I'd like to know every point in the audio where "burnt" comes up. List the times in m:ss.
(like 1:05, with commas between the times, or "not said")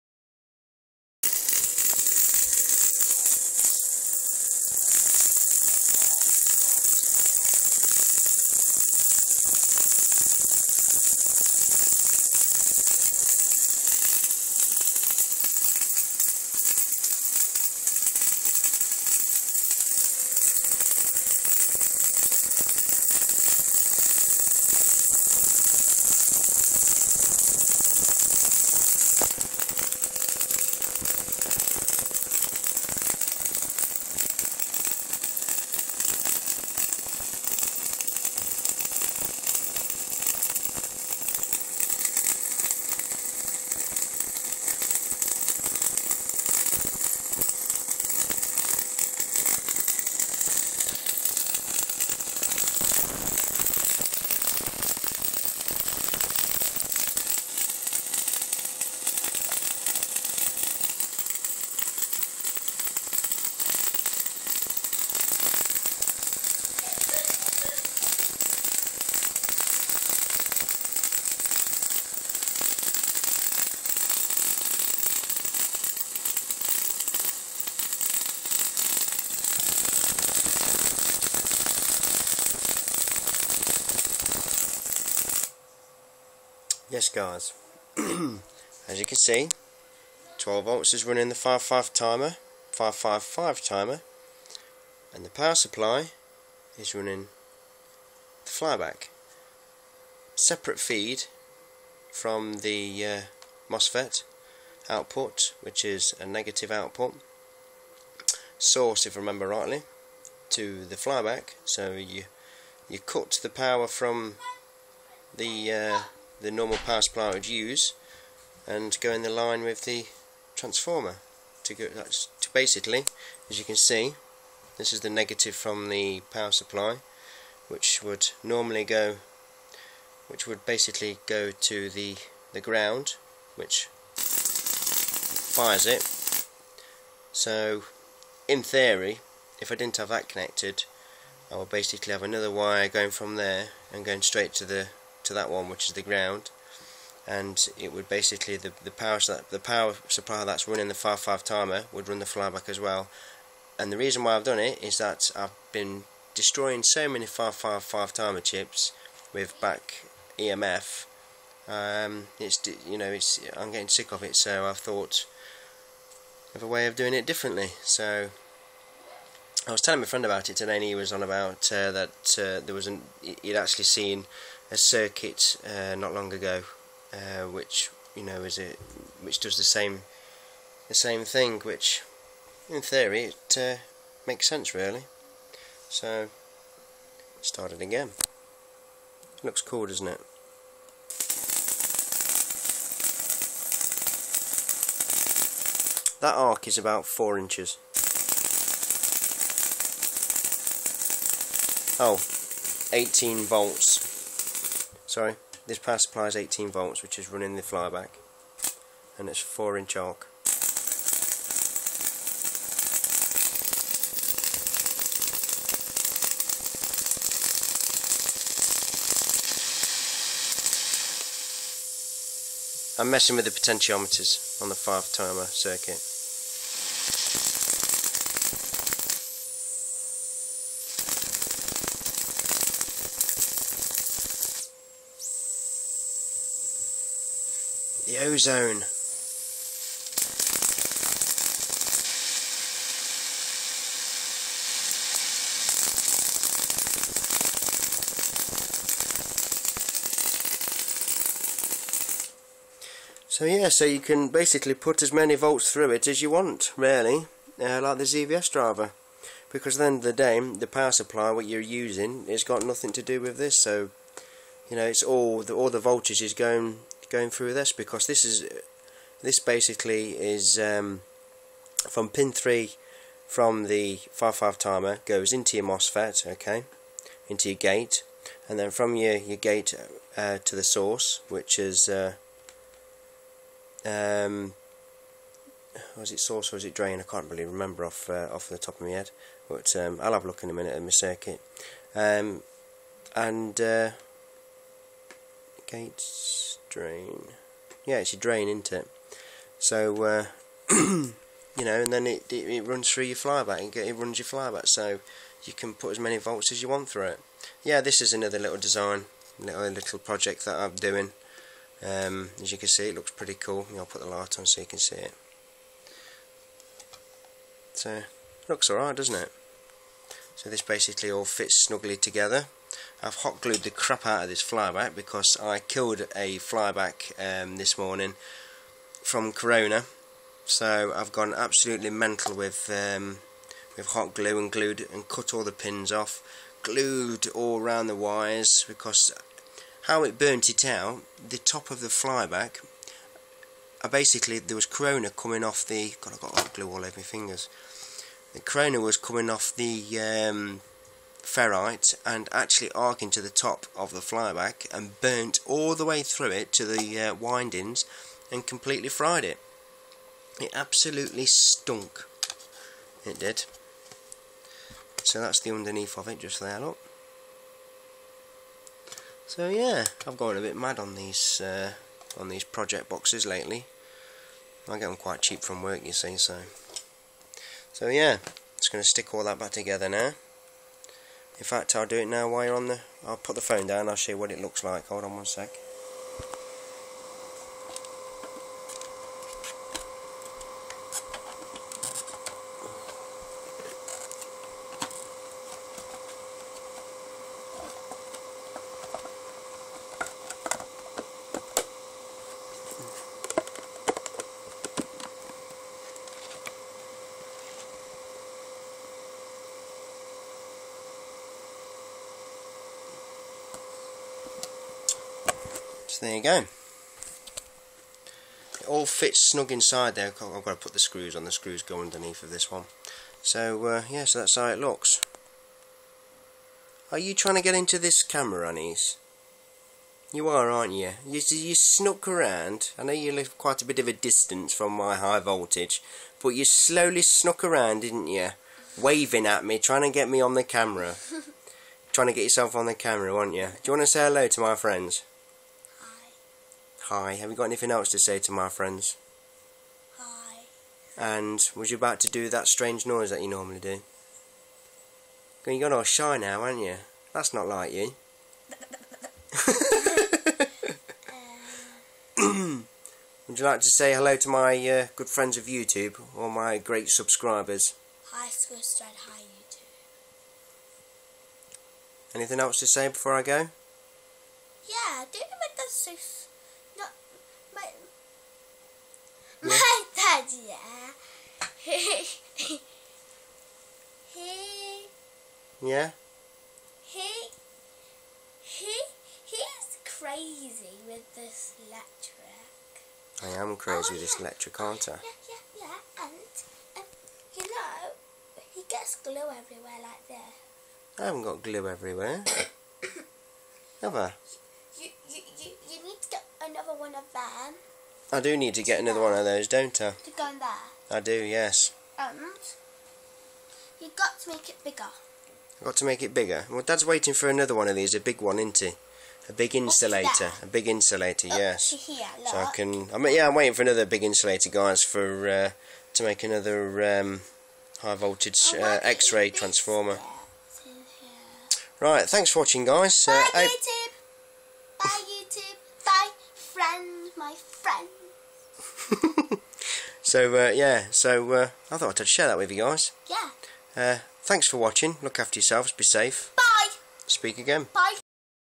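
5:40, 5:55.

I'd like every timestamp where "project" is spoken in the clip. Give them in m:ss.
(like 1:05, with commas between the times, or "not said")
5:09, 6:12.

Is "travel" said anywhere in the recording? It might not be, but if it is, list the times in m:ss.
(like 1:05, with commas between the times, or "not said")
not said.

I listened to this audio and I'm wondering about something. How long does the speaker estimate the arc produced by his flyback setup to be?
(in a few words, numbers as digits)
Four inches.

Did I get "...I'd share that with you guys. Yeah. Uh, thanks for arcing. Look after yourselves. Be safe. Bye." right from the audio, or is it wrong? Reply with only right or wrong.
wrong.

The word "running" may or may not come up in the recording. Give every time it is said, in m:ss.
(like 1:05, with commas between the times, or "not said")
1:31, 1:36, 2:30, 3:27.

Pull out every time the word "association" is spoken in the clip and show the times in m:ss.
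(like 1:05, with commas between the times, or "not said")
not said.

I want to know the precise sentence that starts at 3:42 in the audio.
I'm messing with the potentiometers on the 5 timer circuit.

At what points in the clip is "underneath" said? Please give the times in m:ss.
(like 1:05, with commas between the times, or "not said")
6:05, 7:01.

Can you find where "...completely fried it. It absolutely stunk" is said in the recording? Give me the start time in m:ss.
5:58.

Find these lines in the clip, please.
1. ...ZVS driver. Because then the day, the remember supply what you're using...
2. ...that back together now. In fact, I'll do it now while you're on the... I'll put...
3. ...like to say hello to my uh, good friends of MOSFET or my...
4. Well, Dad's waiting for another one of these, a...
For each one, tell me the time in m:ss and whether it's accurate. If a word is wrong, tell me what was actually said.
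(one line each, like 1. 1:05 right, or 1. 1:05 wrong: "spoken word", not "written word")
1. 4:18 wrong: "power", not "remember"
2. 6:19 right
3. 7:43 wrong: "YouTube", not "MOSFET"
4. 8:36 right.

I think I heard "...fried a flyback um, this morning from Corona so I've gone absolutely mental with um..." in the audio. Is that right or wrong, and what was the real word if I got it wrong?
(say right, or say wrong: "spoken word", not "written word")
wrong: "killed", not "fried".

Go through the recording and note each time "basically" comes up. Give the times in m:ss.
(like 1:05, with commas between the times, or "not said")
2:02, 2:10, 2:21, 2:28, 4:14, 4:29, 5:20, 5:43.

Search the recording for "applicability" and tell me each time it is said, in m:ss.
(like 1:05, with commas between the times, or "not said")
not said.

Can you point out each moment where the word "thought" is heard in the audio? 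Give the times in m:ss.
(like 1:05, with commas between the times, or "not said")
2:44, 9:01.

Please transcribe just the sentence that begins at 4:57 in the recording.
Yeah, it's your drain, isn't it?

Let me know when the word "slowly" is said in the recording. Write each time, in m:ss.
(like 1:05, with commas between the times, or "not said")
7:16.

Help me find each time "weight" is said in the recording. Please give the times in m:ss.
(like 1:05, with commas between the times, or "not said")
not said.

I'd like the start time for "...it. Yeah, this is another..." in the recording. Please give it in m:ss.
5:07.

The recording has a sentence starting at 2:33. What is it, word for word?
And the reason why I've done it is that I've been destroying so many five five five timer chips with back EMF.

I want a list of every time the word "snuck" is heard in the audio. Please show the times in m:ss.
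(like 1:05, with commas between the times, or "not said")
7:11, 7:17.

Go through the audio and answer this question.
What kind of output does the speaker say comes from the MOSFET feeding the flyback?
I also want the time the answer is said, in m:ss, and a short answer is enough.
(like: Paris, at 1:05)
Negative output, at 1:46.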